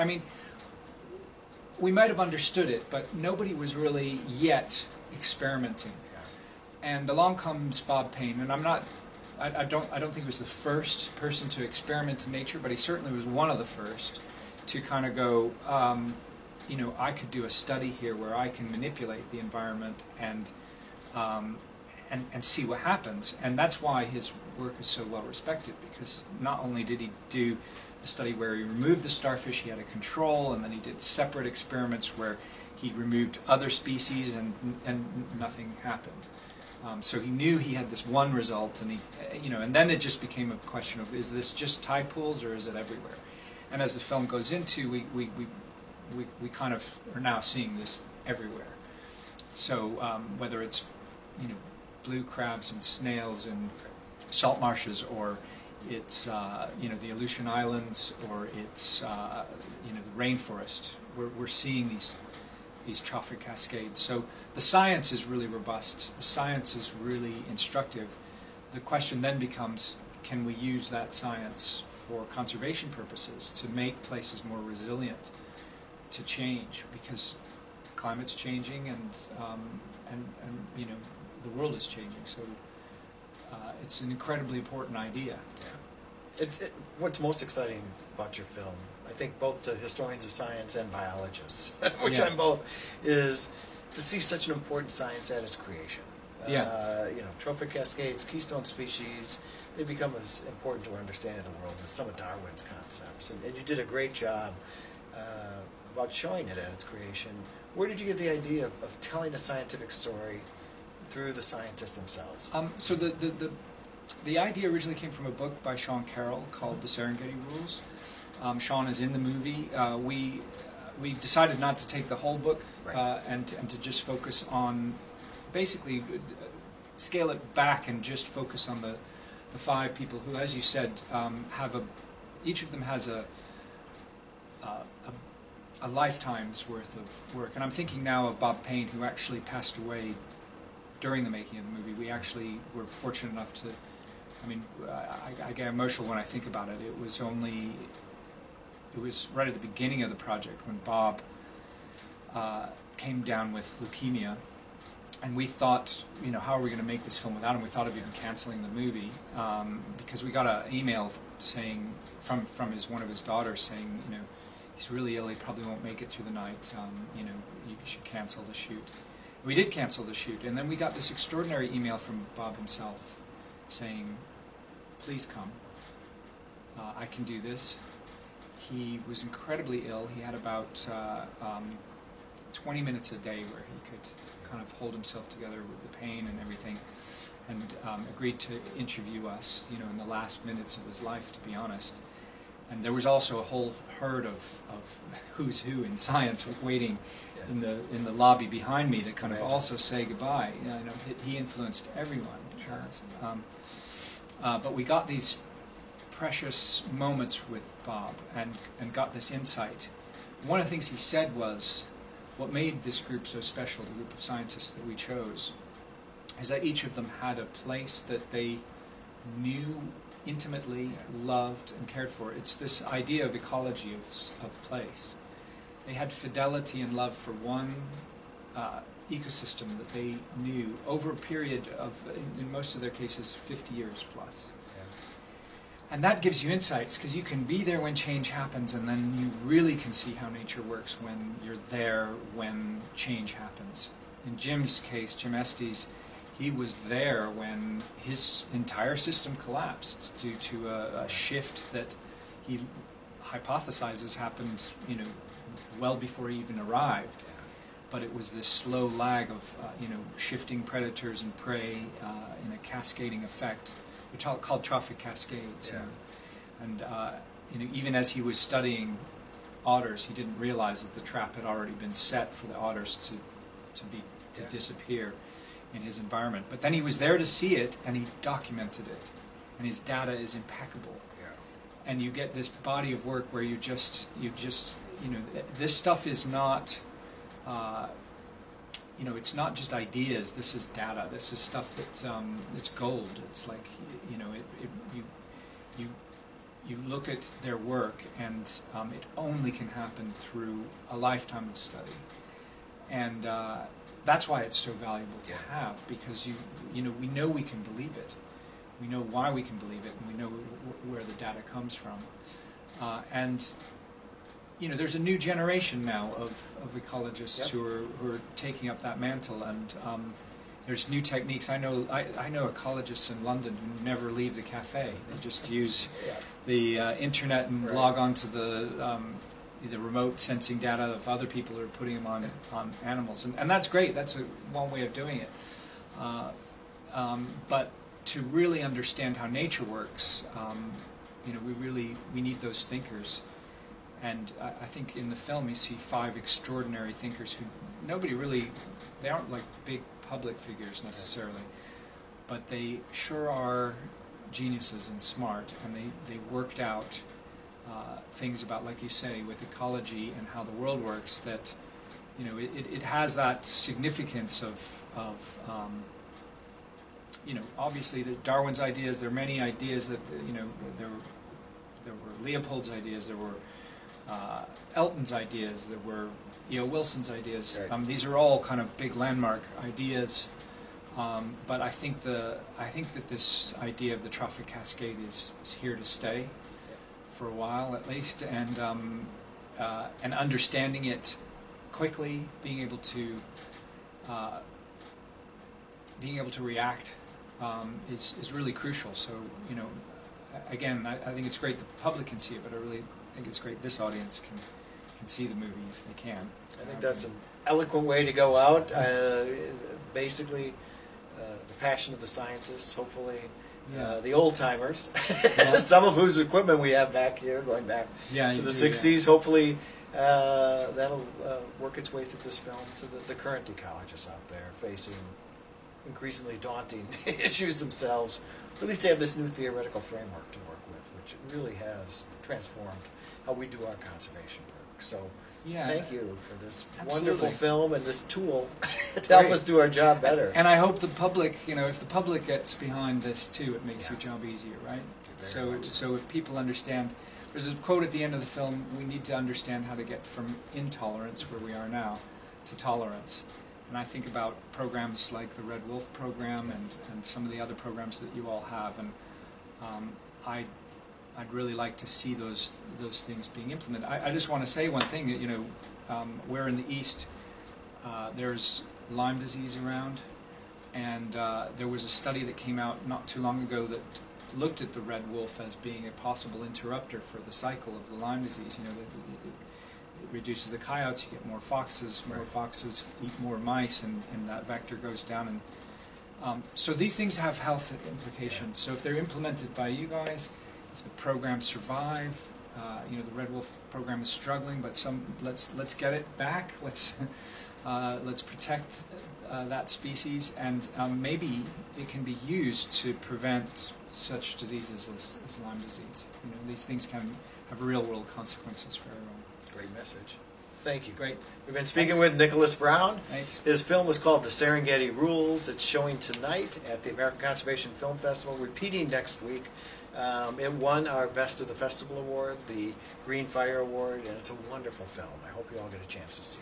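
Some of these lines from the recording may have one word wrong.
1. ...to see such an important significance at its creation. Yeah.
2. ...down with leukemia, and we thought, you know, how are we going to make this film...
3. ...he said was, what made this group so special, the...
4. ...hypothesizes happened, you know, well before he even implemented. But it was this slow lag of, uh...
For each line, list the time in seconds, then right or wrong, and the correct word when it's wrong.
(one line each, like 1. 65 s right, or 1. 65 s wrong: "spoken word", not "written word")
1. 93 s wrong: "science", not "significance"
2. 153 s right
3. 210 s right
4. 253 s wrong: "arrived", not "implemented".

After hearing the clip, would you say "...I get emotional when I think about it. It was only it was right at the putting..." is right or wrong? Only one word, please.
wrong.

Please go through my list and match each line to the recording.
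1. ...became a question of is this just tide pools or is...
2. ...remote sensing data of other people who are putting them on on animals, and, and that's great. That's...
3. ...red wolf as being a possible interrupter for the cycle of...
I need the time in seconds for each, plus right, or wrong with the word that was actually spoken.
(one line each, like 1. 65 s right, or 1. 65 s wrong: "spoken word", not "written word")
1. 40 s right
2. 329 s right
3. 474 s right.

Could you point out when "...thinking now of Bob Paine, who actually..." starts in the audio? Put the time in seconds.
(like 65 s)
137 s.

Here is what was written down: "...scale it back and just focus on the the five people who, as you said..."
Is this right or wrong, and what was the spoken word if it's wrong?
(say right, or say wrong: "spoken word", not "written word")
right.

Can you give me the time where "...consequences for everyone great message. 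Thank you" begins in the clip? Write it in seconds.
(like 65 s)
508 s.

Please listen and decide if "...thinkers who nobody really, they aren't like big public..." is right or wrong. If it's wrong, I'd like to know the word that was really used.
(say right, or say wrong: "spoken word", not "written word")
right.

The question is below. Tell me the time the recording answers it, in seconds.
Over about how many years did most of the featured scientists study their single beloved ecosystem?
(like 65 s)
233 s.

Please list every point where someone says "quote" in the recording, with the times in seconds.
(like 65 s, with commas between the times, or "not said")
447 s.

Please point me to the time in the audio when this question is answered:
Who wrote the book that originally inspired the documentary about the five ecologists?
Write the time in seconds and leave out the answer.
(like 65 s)
115 s.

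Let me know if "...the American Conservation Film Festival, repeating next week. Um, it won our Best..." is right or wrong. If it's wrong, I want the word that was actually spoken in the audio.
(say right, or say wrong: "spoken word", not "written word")
right.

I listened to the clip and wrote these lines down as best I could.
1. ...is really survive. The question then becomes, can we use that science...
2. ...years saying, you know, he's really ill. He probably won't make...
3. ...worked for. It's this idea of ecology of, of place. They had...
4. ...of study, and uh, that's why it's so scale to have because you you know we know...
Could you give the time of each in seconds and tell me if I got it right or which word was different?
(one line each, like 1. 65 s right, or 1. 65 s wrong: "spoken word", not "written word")
1. 66 s wrong: "instructive", not "survive"
2. 163 s wrong: "daughters", not "years"
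3. 221 s wrong: "cared", not "worked"
4. 301 s wrong: "valuable", not "scale".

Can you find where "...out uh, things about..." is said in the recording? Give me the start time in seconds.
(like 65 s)
356 s.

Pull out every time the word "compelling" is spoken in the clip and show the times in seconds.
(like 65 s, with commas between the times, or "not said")
not said.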